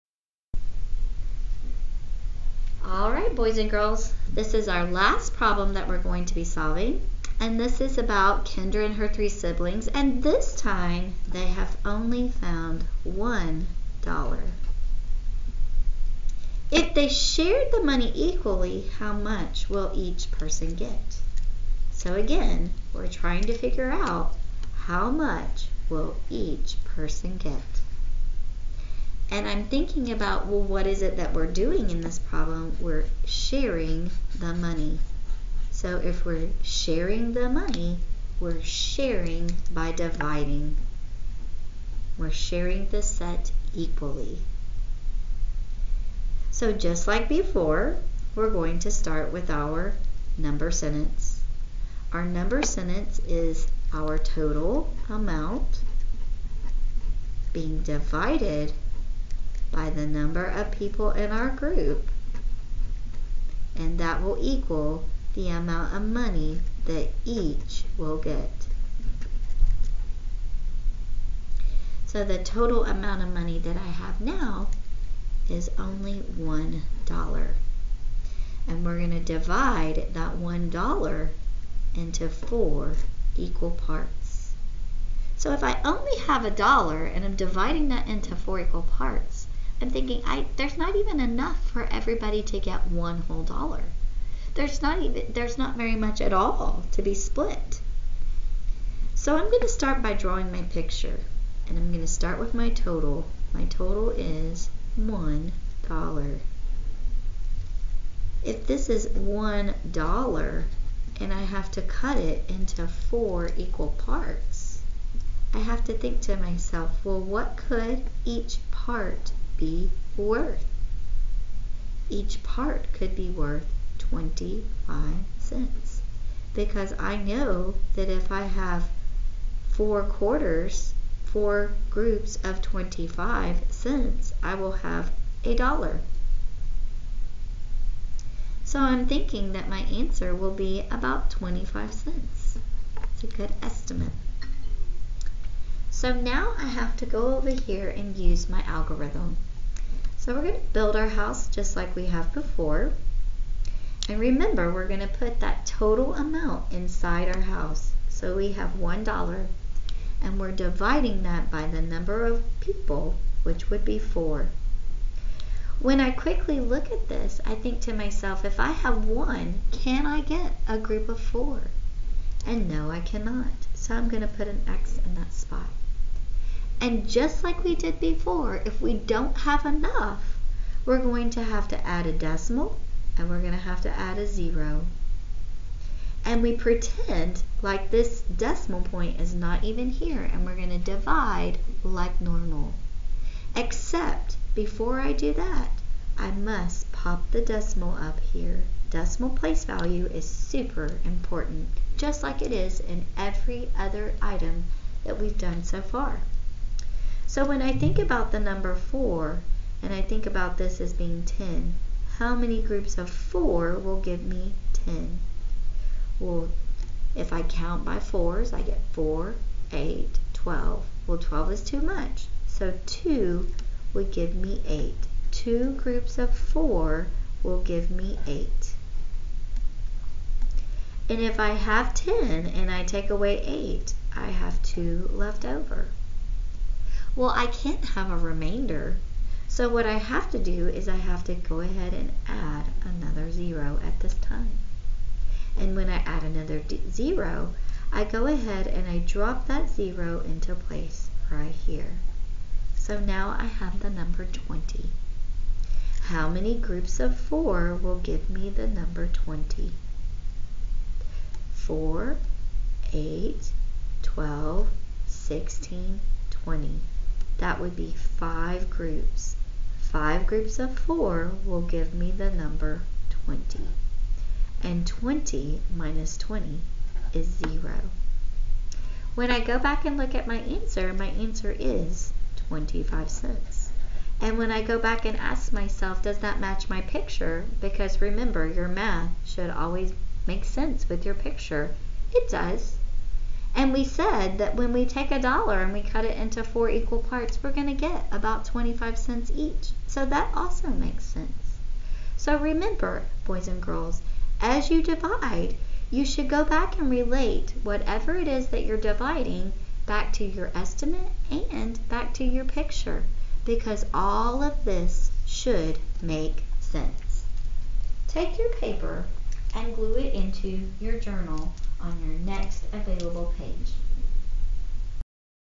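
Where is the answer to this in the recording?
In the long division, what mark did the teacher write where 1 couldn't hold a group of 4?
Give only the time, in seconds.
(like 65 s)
174 s.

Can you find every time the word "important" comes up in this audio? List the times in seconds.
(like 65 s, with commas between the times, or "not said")
201 s.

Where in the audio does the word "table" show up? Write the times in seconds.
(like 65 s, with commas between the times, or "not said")
not said.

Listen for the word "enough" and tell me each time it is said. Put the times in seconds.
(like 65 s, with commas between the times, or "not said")
91 s, 179 s.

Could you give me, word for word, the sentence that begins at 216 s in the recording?
Well, if I count by 4s, I get 4, 8, 12.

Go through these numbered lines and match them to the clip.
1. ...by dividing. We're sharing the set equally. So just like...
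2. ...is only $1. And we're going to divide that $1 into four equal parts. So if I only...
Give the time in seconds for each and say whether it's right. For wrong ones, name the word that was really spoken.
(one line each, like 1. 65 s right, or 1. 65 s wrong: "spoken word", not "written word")
1. 39 s right
2. 75 s right.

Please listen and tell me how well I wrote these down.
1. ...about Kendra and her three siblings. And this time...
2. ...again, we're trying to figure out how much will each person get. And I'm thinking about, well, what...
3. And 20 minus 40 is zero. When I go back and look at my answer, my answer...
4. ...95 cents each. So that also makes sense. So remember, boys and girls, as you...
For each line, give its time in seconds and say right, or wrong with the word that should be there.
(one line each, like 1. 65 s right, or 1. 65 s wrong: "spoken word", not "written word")
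1. 7 s right
2. 22 s right
3. 274 s wrong: "20", not "40"
4. 298 s wrong: "25", not "95".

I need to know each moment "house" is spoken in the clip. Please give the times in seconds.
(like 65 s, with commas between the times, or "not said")
151 s, 157 s.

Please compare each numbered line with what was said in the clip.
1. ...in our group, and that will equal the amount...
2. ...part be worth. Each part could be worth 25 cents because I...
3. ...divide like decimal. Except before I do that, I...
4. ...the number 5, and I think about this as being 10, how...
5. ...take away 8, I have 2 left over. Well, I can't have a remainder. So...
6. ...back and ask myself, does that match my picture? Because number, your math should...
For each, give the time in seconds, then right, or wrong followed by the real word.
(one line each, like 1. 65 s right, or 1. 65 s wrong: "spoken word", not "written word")
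1. 61 s right
2. 118 s right
3. 190 s wrong: "normal", not "decimal"
4. 208 s wrong: "4", not "5"
5. 232 s right
6. 284 s wrong: "remember", not "number".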